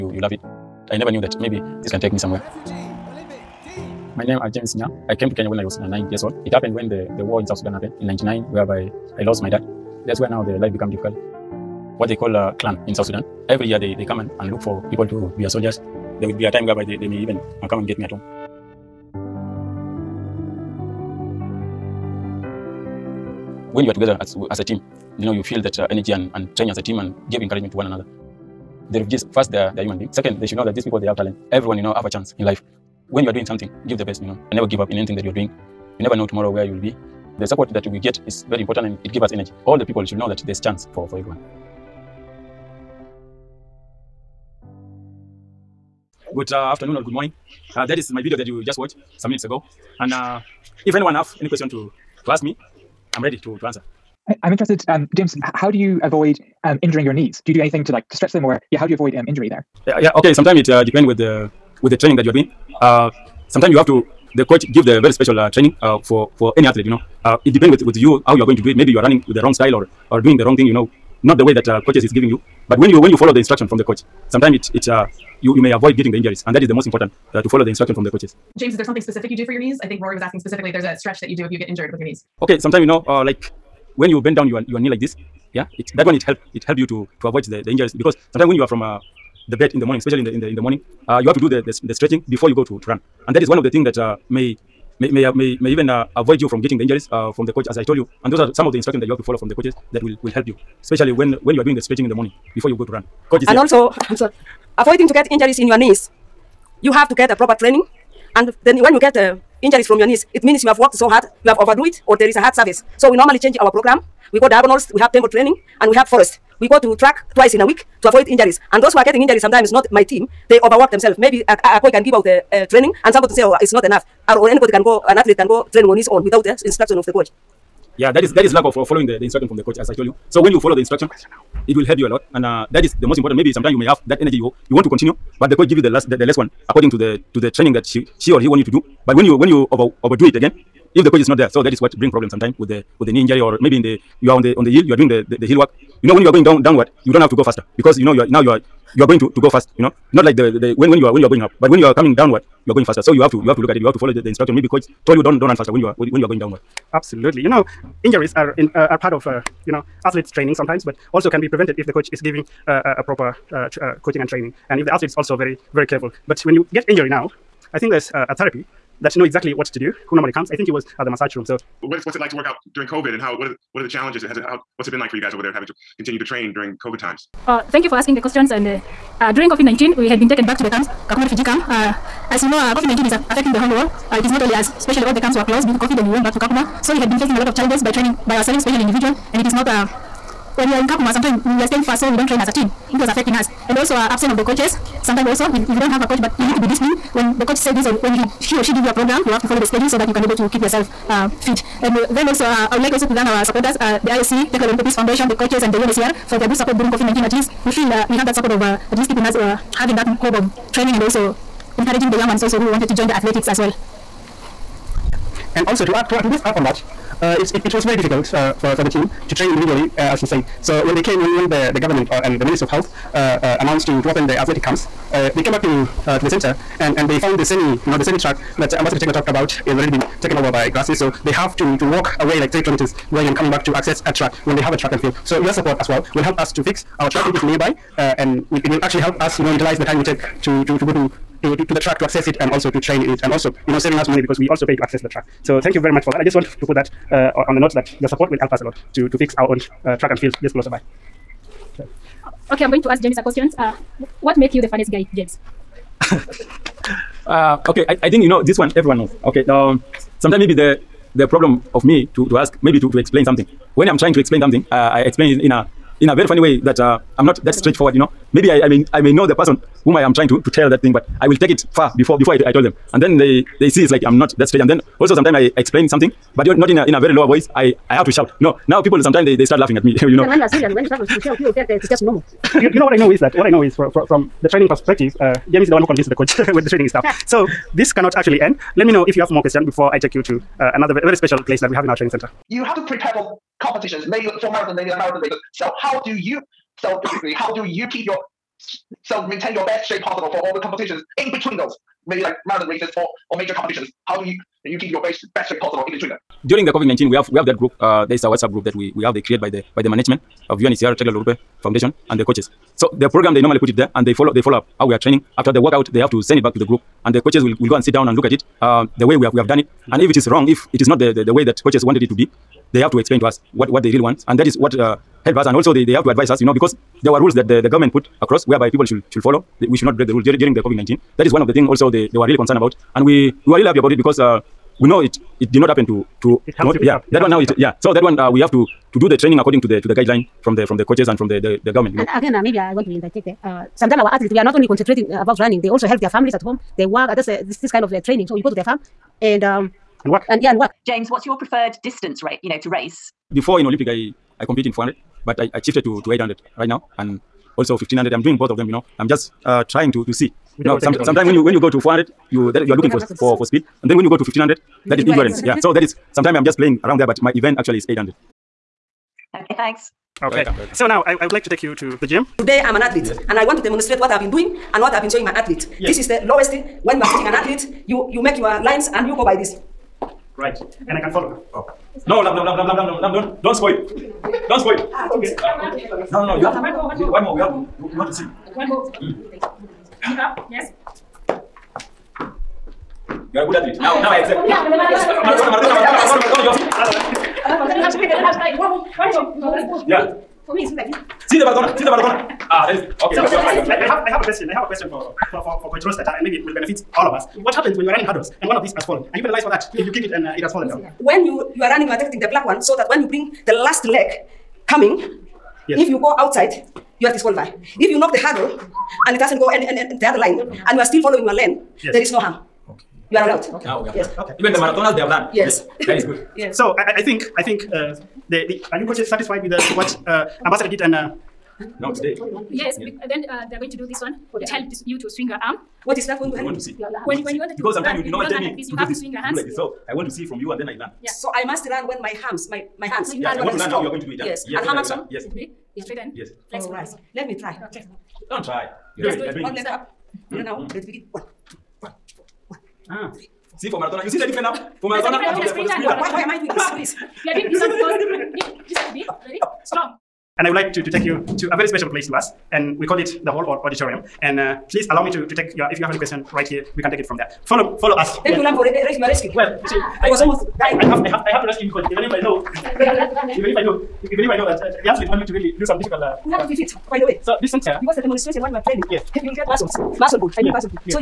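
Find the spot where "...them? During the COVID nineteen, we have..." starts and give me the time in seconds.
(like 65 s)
306 s.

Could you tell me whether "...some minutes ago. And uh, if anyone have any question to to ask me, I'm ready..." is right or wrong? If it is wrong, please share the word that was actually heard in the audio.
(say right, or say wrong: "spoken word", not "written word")
right.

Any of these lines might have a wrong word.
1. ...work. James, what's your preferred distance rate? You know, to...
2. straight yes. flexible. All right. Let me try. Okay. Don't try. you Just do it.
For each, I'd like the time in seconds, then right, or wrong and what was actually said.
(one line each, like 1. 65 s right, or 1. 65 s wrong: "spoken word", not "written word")
1. 350 s right
2. 445 s right.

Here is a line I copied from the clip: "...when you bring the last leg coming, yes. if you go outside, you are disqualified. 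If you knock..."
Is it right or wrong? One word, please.
right.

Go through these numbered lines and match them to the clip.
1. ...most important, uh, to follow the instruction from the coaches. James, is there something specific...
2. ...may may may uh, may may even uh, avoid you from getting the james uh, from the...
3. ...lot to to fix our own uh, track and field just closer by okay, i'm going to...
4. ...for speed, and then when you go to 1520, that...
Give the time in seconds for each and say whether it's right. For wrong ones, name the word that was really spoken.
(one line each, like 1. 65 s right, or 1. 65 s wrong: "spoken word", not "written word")
1. 76 s right
2. 94 s wrong: "injuries", not "james"
3. 248 s right
4. 363 s wrong: "1500", not "1520".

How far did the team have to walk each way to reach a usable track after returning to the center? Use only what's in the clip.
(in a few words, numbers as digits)
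3 kilometers.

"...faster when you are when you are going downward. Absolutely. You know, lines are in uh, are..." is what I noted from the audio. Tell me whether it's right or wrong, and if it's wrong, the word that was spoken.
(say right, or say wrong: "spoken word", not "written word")
wrong: "injuries", not "lines".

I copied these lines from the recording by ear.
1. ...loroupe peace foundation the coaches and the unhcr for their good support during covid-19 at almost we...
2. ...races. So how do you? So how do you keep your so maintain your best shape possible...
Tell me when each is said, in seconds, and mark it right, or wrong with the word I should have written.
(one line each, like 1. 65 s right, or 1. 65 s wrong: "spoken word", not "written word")
1. 204 s wrong: "least", not "almost"
2. 295 s right.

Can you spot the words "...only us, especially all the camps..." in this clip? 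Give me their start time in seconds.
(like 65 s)
184 s.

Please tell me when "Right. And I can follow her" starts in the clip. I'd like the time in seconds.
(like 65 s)
380 s.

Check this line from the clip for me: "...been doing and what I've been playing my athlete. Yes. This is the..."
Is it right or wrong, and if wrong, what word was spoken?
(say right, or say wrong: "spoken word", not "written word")
wrong: "showing", not "playing".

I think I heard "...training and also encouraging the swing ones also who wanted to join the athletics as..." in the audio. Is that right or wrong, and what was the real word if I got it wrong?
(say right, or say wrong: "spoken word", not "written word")
wrong: "young", not "swing".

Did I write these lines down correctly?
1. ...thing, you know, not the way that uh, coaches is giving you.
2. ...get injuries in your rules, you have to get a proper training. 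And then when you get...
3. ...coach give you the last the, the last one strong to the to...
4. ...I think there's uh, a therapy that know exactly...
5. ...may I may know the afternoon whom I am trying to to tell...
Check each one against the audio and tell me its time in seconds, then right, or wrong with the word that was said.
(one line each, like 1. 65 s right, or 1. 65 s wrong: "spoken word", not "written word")
1. 70 s right
2. 105 s wrong: "knees", not "rules"
3. 135 s wrong: "according", not "strong"
4. 167 s right
5. 268 s wrong: "person", not "afternoon".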